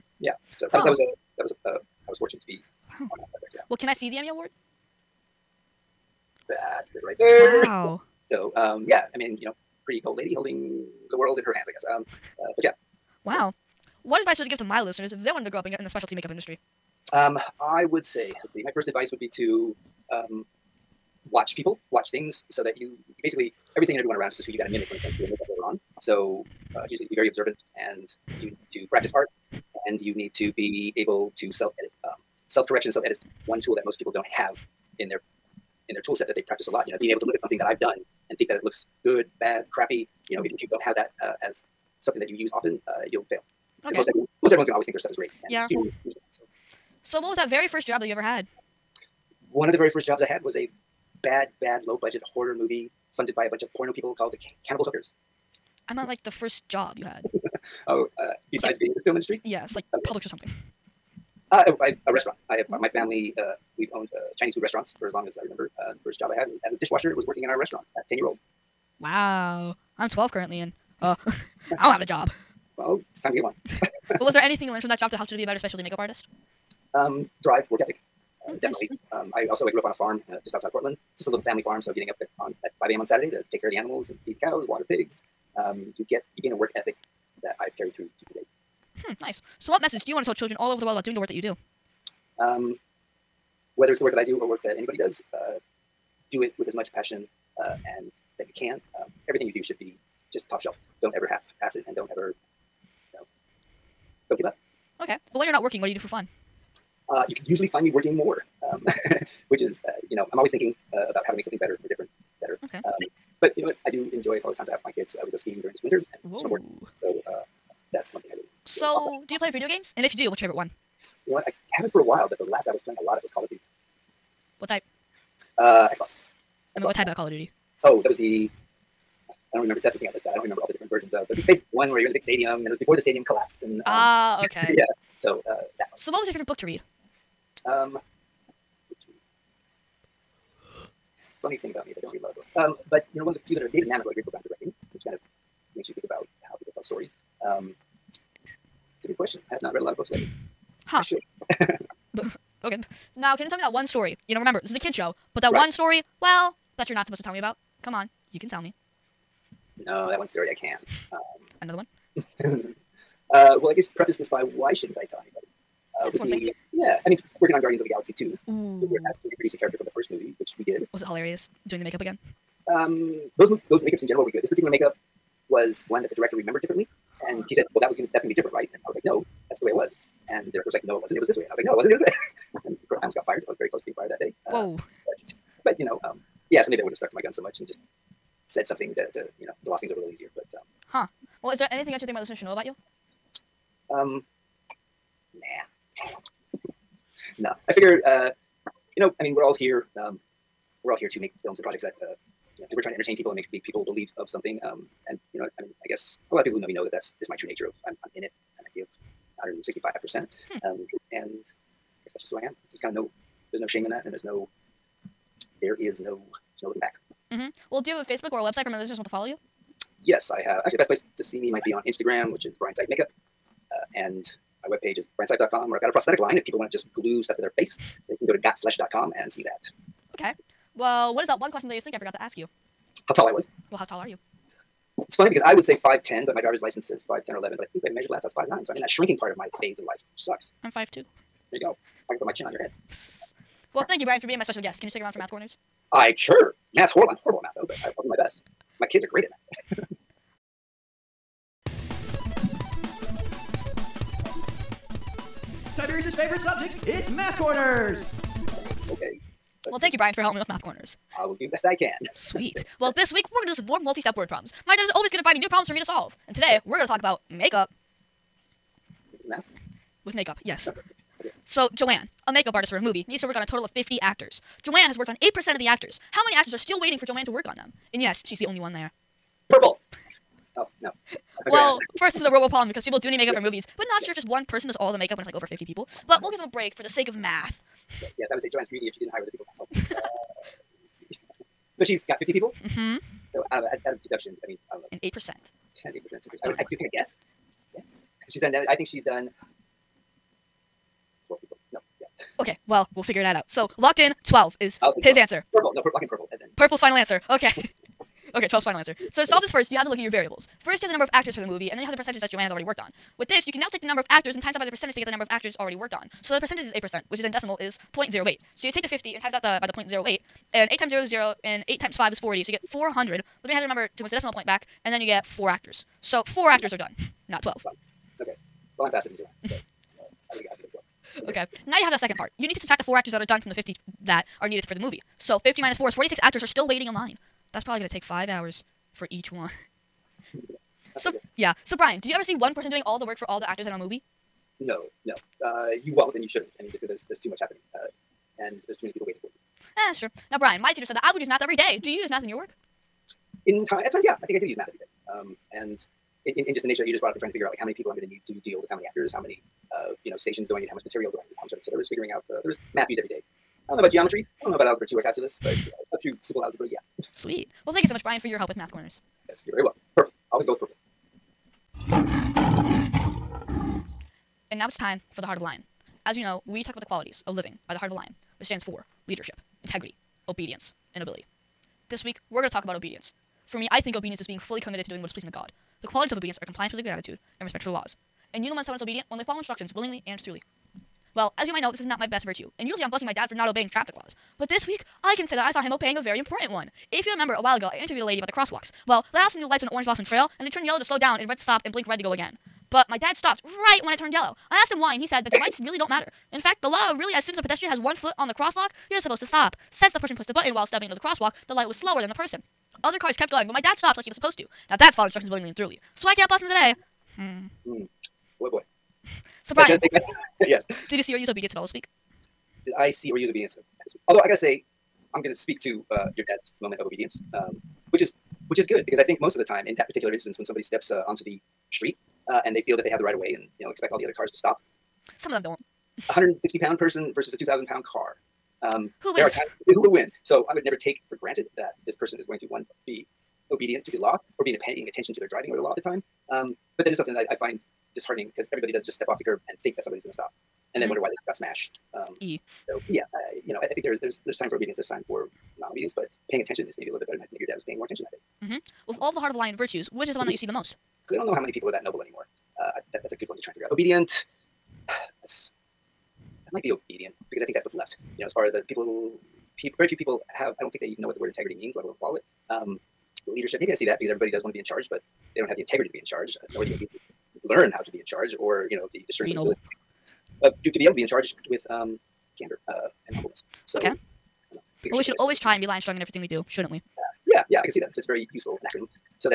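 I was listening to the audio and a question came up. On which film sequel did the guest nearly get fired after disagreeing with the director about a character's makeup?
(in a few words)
Guardians of the Galaxy 2.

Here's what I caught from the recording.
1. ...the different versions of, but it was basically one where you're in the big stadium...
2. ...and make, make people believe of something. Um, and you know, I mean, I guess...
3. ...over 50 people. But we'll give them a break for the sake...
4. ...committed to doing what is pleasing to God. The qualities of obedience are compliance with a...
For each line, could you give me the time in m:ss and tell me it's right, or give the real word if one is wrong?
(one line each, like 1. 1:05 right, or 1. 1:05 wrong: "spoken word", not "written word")
1. 2:10 right
2. 3:23 right
3. 4:45 right
4. 6:24 right.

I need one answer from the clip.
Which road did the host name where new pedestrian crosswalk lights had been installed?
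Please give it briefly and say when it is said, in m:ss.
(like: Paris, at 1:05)
Orange Blossom Trail, at 6:39.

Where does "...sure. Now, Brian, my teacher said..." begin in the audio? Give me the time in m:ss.
5:49.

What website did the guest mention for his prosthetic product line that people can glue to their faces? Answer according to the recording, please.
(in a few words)
gotflesh.com.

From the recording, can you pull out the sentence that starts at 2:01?
I haven't for a while, but the last I was playing a lot of was Call of Duty.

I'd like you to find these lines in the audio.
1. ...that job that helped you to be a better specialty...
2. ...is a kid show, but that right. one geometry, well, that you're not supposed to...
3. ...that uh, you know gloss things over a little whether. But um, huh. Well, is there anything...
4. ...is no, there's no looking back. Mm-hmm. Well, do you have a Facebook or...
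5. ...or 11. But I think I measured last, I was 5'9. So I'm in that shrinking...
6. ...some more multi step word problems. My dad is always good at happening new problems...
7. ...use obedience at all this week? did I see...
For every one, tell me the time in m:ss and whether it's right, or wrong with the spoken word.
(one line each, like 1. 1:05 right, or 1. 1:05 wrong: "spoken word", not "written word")
1. 1:14 right
2. 2:34 wrong: "story", not "geometry"
3. 3:08 wrong: "easier", not "whether"
4. 3:35 right
5. 3:57 right
6. 4:23 wrong: "finding", not "happening"
7. 7:01 right.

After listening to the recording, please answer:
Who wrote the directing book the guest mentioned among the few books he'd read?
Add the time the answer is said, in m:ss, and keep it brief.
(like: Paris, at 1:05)
David Mamet, at 2:23.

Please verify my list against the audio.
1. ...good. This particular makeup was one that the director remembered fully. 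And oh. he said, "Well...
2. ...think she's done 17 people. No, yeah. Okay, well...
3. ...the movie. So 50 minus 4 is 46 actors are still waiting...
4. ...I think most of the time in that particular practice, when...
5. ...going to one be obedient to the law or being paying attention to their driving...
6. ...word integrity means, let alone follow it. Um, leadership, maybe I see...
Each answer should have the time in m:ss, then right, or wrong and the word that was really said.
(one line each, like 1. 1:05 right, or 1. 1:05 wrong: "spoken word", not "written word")
1. 2:54 wrong: "differently", not "fully"
2. 4:58 wrong: "12", not "17"
3. 5:34 right
4. 7:08 wrong: "instance", not "practice"
5. 7:22 right
6. 7:51 right.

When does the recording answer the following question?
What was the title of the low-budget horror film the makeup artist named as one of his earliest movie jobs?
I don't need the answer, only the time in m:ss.
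0:54.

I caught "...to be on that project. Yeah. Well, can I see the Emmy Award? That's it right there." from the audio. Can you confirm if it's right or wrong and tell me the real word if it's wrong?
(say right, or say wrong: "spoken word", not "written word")
right.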